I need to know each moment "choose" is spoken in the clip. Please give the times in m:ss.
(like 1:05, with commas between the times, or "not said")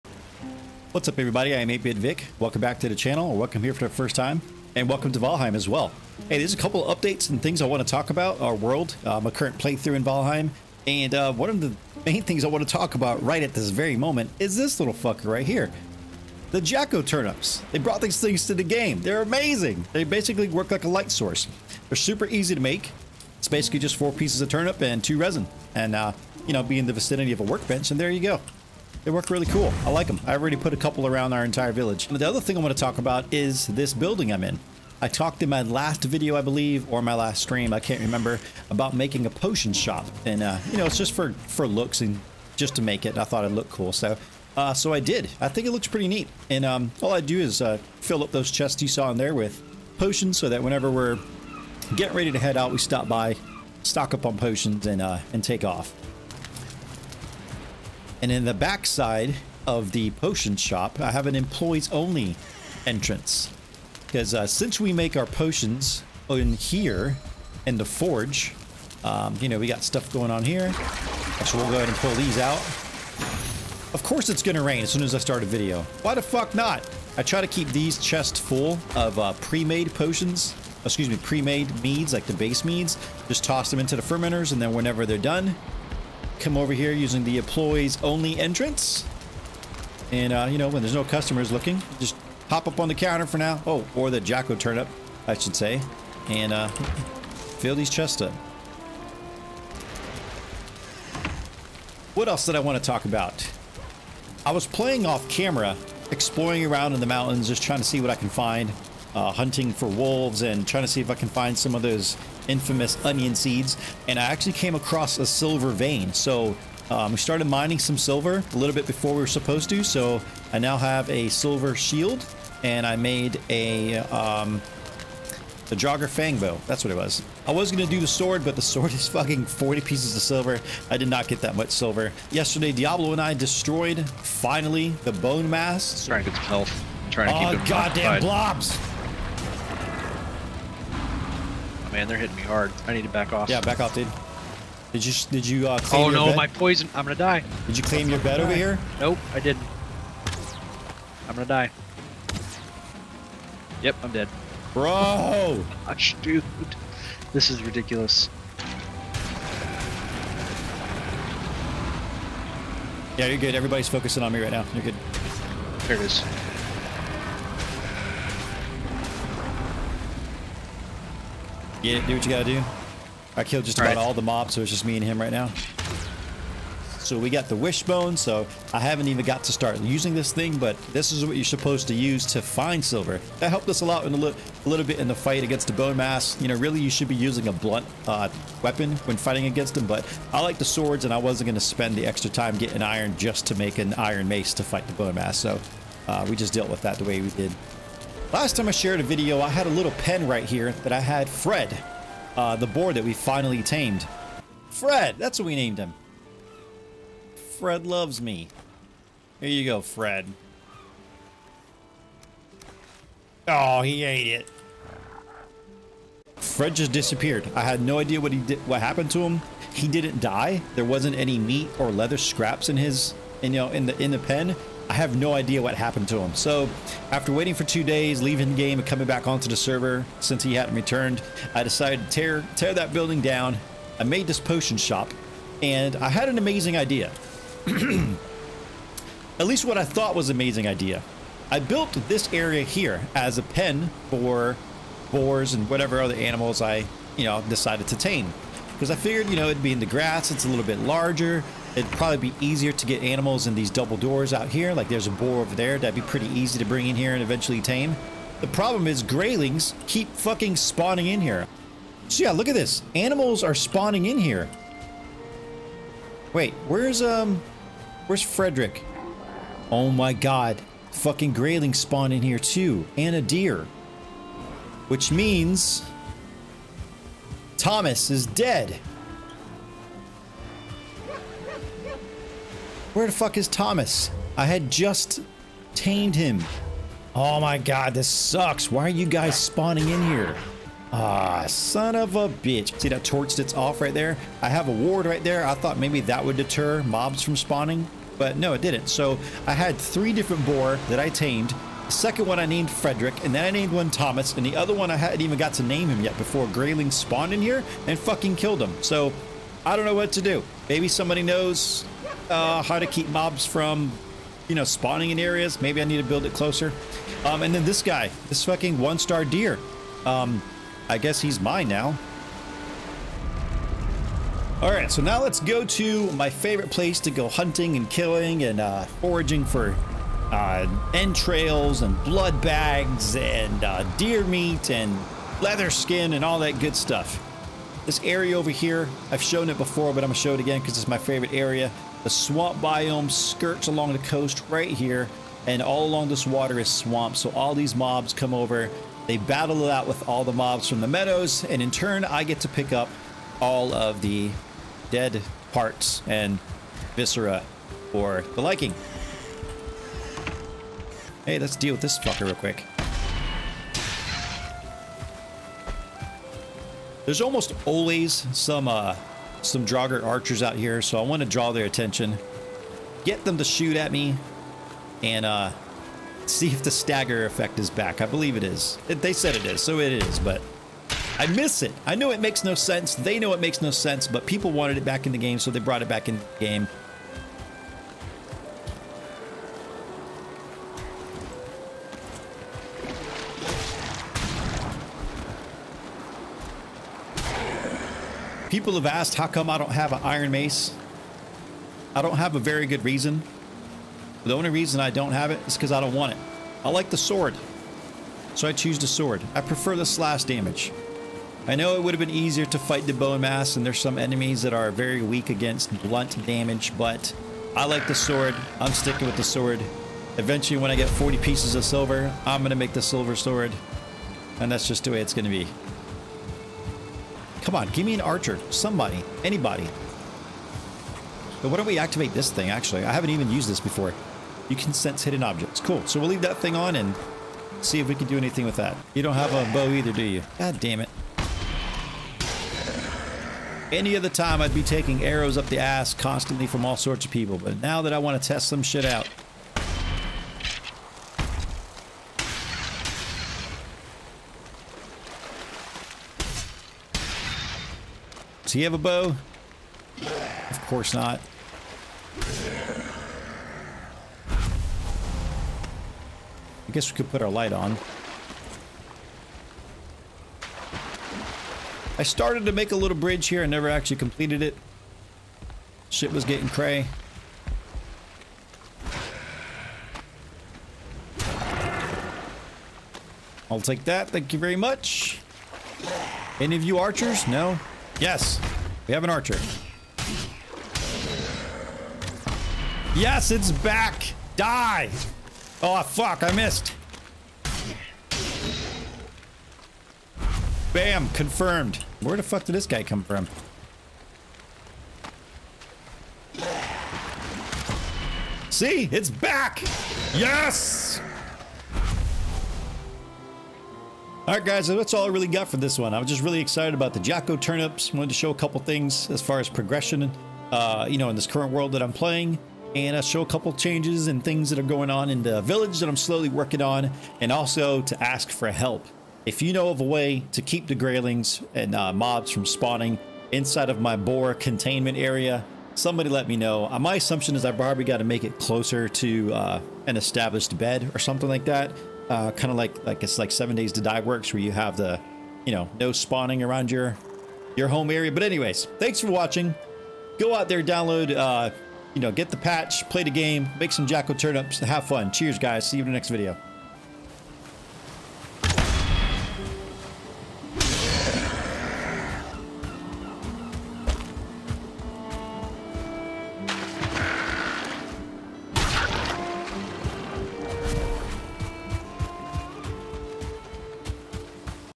6:48.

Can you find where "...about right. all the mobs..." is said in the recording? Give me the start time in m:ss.
2:53.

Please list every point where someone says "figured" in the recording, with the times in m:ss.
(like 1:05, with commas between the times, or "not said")
4:08.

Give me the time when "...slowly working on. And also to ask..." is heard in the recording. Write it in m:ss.
8:45.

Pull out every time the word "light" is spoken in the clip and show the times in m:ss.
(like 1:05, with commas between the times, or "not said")
0:20, 7:47.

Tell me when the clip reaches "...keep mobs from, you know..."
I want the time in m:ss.
5:12.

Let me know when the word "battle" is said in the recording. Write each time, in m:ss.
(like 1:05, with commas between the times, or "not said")
5:49.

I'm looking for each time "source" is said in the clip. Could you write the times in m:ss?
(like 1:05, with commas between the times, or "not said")
0:21.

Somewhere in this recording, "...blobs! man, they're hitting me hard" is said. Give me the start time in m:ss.
2:18.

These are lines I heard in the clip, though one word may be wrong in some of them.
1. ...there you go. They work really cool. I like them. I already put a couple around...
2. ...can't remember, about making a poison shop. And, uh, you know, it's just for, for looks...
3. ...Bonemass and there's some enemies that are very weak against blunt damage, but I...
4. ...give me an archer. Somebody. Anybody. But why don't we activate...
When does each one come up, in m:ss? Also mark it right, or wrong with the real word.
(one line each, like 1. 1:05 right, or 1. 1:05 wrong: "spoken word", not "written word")
1. 0:27 right
2. 0:37 wrong: "potion", not "poison"
3. 6:52 right
4. 7:07 right.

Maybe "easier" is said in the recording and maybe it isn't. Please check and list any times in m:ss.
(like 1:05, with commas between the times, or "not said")
4:12, 6:52.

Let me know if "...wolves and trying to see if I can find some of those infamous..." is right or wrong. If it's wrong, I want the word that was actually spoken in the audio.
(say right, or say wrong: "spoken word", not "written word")
right.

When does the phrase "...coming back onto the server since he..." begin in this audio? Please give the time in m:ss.
3:48.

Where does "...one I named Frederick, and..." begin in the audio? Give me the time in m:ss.
5:02.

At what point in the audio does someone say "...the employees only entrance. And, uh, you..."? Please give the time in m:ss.
1:27.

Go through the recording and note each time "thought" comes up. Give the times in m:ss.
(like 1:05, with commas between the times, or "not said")
0:43, 3:59, 4:55.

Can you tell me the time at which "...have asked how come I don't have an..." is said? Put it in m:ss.
6:38.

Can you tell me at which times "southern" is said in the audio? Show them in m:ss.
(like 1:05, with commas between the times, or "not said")
not said.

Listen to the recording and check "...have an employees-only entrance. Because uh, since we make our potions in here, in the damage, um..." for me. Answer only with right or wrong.
wrong.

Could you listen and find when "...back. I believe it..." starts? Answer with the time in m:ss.
6:17.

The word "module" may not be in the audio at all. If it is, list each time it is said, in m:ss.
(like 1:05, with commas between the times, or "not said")
not said.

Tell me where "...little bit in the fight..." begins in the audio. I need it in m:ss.
3:04.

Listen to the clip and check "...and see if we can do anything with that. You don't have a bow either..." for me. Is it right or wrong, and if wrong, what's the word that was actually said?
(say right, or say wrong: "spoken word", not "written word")
right.